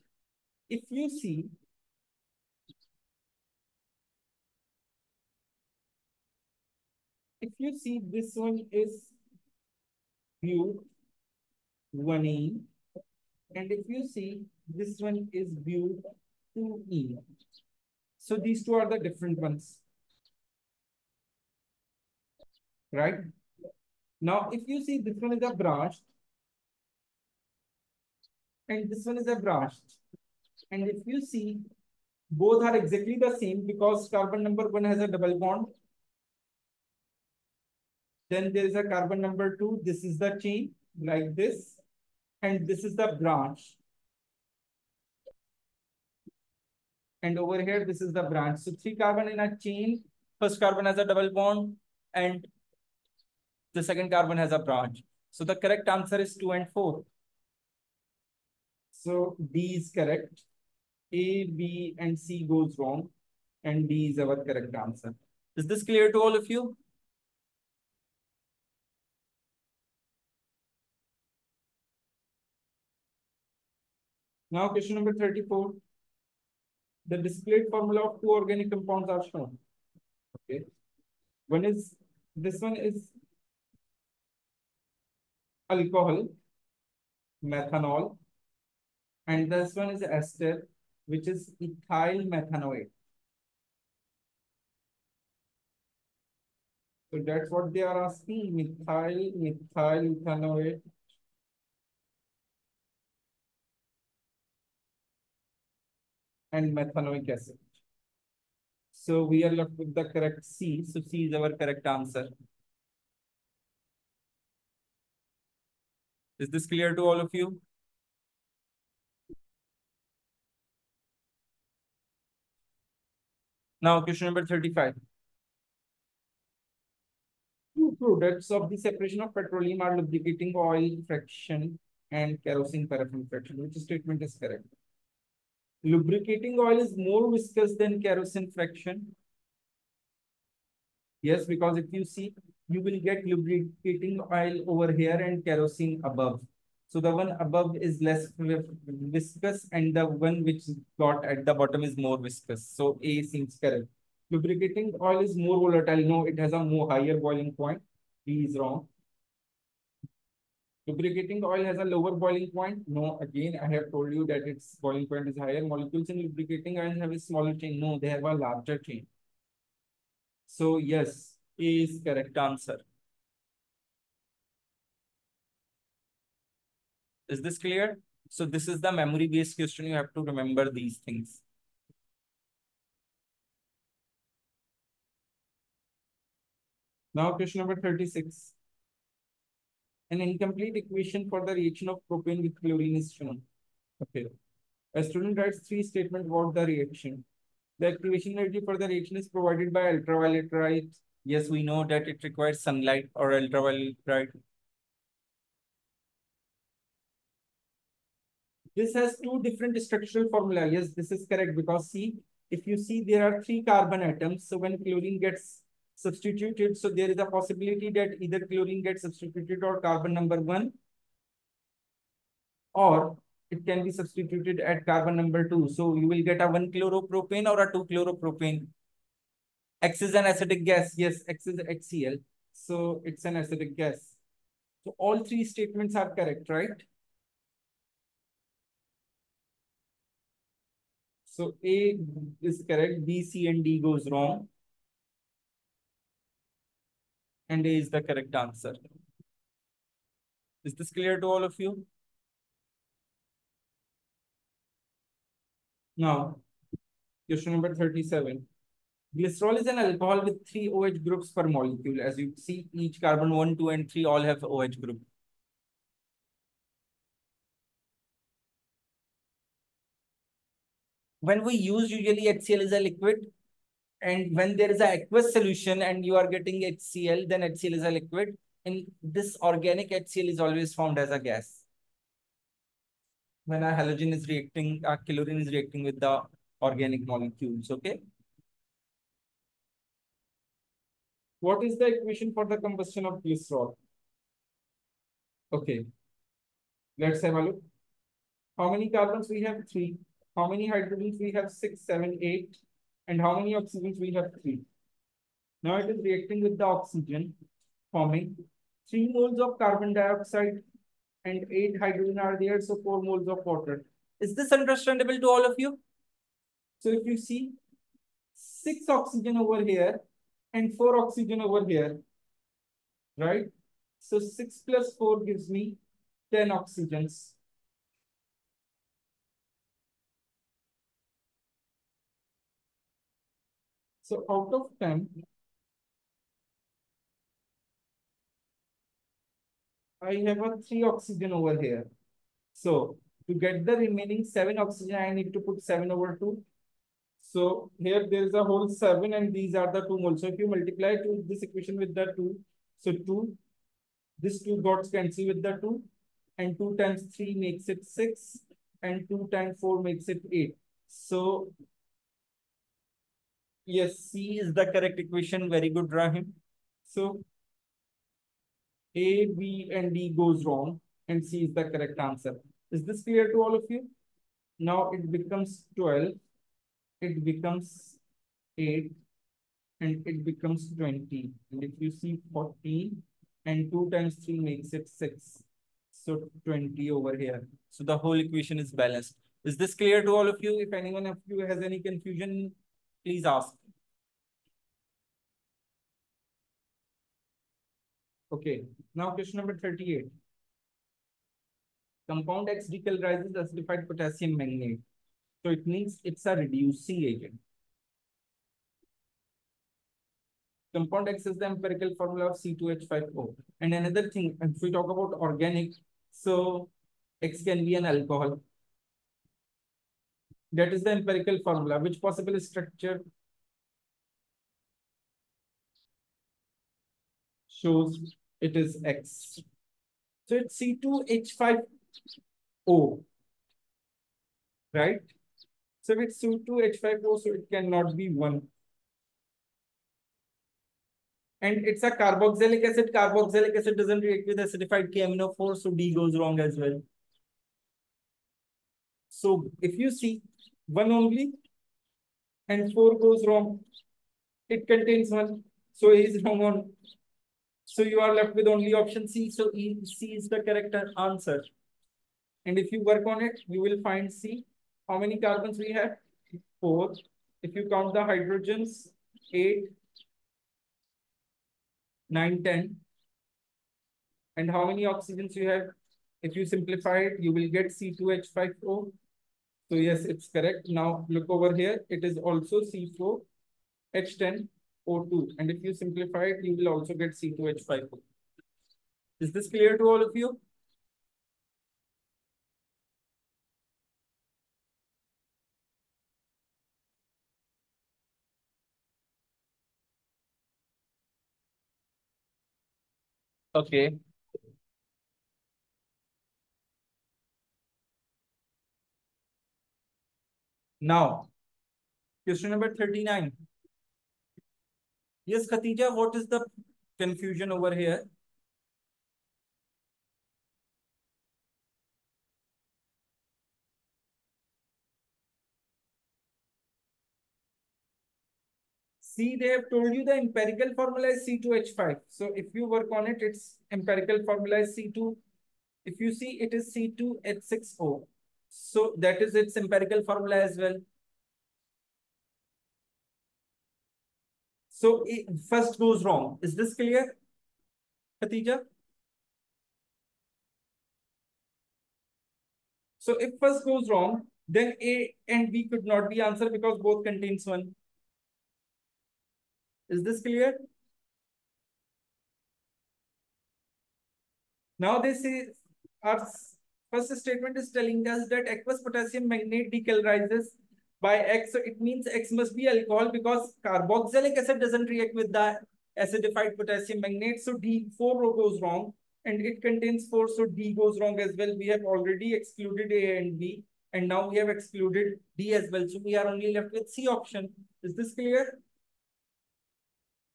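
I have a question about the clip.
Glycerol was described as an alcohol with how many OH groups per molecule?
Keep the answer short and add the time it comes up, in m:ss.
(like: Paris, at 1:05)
3, at 4:20.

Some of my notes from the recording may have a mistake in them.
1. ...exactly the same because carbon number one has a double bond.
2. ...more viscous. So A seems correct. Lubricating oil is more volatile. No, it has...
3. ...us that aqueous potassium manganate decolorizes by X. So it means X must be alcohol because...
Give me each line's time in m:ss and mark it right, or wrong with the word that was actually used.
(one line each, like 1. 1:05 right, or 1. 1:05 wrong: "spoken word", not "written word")
1. 0:32 right
2. 2:31 right
3. 9:28 right.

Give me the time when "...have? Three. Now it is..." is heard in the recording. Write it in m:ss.
5:04.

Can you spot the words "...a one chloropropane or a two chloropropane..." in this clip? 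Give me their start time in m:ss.
3:46.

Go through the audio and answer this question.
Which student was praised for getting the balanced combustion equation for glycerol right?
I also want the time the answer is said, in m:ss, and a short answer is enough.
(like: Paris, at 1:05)
Rahim, at 6:05.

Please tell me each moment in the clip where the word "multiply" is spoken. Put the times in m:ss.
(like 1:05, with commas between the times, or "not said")
5:50.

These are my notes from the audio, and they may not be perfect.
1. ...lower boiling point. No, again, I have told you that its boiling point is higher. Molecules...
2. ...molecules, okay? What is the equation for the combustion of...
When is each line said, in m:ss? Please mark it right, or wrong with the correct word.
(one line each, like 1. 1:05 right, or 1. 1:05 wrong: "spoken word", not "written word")
1. 2:41 right
2. 4:47 right.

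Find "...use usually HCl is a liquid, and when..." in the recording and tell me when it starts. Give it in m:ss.
4:31.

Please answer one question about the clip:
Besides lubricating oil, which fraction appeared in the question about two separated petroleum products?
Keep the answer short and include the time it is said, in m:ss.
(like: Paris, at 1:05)
kerosene paraffin fraction, at 2:12.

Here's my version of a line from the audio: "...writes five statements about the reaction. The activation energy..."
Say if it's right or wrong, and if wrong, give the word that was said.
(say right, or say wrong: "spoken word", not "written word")
wrong: "three", not "five".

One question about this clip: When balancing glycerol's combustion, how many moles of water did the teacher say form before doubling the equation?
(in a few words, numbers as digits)
4.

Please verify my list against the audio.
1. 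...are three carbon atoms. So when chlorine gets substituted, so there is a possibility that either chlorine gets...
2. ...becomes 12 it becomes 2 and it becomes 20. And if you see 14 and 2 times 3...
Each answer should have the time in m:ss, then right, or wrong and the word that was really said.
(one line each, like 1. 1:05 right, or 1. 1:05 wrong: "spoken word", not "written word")
1. 3:33 right
2. 6:15 wrong: "8", not "2".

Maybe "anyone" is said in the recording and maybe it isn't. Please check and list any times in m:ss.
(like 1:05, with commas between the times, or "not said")
6:30.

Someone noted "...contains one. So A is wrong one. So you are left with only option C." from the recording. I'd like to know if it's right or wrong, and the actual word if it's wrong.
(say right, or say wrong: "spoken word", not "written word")
right.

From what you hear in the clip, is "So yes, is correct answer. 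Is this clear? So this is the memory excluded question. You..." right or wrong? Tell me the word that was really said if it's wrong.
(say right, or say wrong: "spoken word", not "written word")
wrong: "based", not "excluded".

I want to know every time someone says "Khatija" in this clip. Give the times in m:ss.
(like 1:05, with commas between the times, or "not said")
8:35, 9:08.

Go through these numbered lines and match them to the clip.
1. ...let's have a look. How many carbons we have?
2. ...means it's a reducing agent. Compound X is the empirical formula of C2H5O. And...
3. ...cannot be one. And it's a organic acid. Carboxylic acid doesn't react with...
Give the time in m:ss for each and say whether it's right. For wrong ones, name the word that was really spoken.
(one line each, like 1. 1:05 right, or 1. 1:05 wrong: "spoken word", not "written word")
1. 4:56 right
2. 6:45 right
3. 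7:17 wrong: "carboxylic", not "organic".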